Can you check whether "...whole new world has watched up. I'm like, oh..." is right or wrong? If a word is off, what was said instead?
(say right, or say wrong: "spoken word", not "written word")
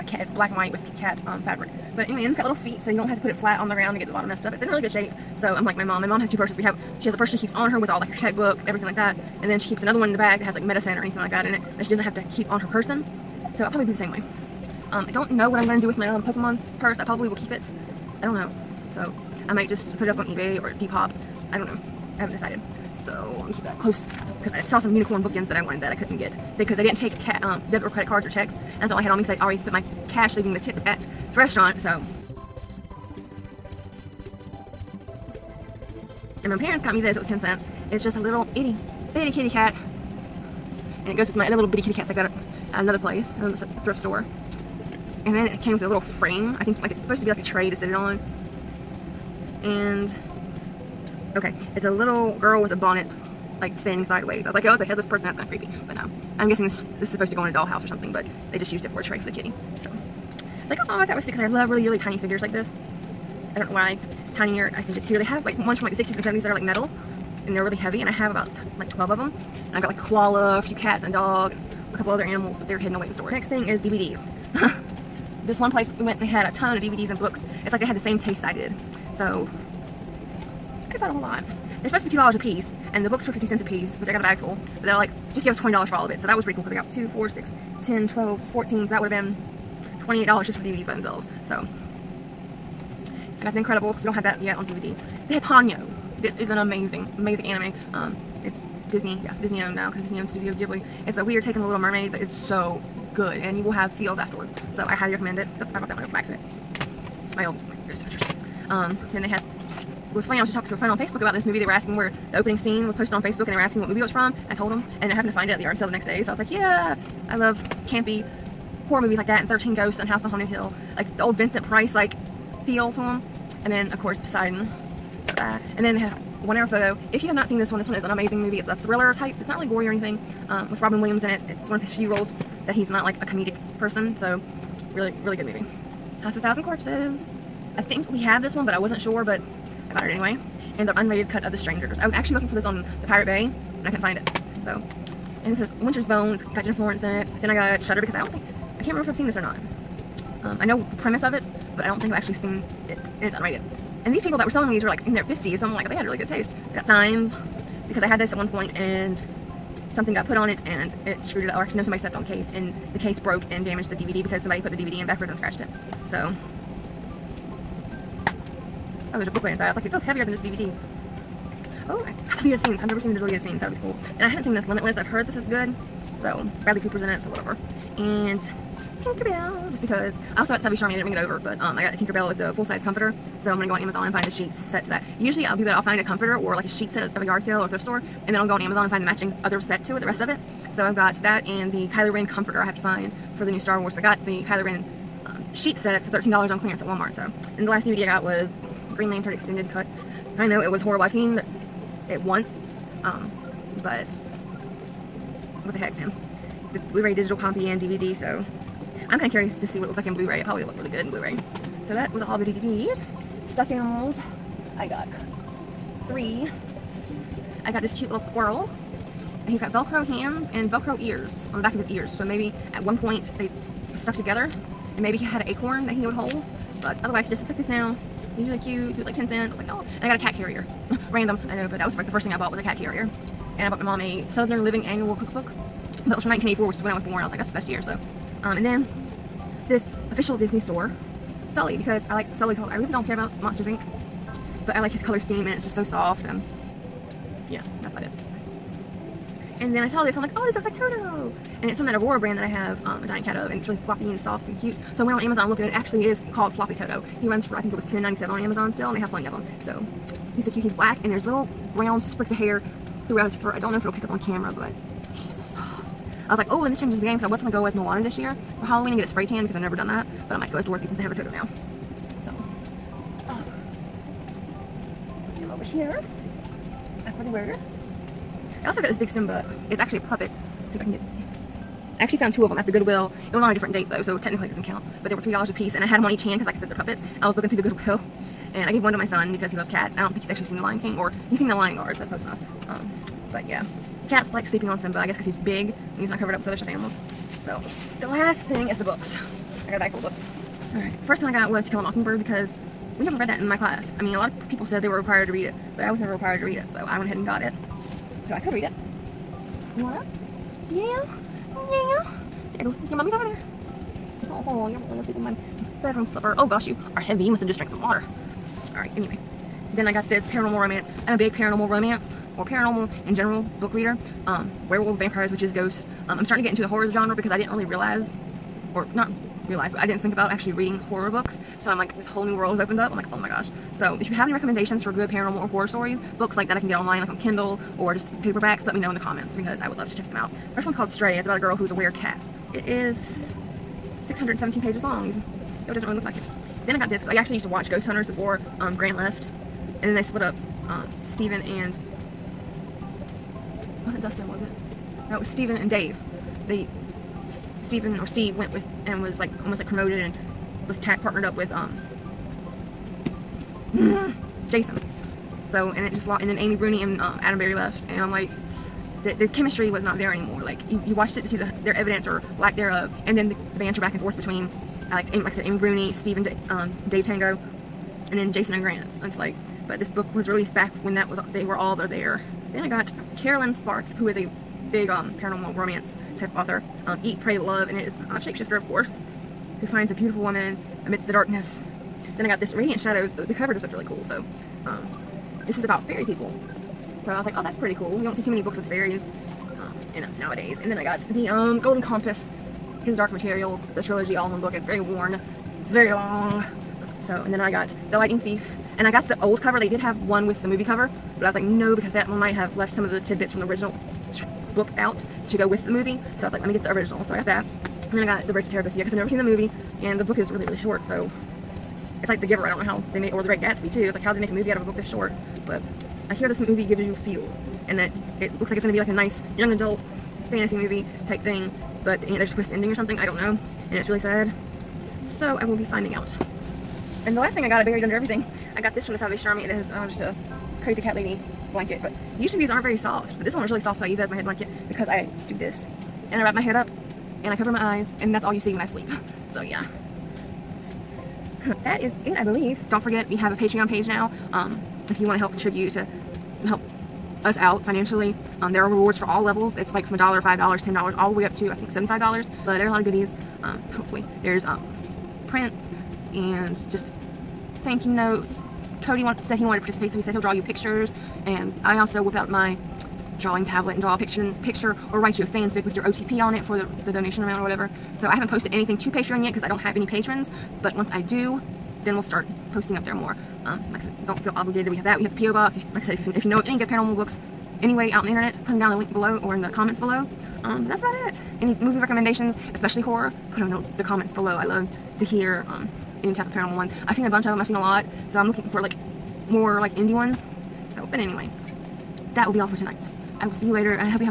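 wrong: "opened", not "watched".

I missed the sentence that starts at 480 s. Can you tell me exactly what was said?
But once I do, then we'll start posting up there more.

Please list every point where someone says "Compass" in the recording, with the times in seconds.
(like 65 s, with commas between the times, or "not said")
401 s.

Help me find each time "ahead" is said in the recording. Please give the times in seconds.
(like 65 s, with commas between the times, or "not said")
307 s.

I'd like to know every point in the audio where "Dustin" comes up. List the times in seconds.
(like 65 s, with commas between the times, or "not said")
354 s.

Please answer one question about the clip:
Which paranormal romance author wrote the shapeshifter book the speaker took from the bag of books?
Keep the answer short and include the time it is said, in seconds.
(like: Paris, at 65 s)
Kerrelyn Sparks, at 383 s.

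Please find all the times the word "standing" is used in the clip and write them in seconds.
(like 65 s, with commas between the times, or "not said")
53 s.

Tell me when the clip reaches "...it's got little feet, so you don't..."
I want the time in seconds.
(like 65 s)
2 s.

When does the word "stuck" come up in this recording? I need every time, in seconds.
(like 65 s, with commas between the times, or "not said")
223 s.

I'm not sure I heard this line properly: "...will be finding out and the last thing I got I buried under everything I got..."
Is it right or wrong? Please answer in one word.
right.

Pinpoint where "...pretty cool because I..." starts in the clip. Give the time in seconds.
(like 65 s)
86 s.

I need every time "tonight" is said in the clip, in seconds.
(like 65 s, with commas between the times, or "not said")
502 s.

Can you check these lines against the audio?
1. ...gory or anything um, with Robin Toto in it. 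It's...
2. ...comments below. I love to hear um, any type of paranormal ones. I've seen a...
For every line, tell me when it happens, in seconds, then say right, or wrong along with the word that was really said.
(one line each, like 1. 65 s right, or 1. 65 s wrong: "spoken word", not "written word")
1. 129 s wrong: "Williams", not "Toto"
2. 493 s right.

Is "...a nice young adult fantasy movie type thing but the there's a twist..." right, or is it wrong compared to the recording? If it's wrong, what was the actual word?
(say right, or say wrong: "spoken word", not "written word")
right.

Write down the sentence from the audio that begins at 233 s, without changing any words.
And I bought my mom a Southern Living Annual Cookbook.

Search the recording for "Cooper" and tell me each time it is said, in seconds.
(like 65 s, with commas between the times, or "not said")
176 s.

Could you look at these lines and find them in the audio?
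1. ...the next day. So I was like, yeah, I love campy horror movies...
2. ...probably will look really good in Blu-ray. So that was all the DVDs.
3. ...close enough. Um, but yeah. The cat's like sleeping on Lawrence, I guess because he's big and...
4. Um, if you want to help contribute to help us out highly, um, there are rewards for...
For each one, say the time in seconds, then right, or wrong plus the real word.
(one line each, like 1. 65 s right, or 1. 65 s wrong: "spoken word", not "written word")
1. 115 s right
2. 210 s right
3. 292 s wrong: "Simba", not "Lawrence"
4. 454 s wrong: "financially", not "highly".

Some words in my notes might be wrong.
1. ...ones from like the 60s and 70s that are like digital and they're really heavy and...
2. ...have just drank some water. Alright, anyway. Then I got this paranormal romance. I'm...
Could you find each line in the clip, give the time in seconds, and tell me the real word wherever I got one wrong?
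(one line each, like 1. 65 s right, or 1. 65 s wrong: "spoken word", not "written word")
1. 65 s wrong: "metal", not "digital"
2. 317 s right.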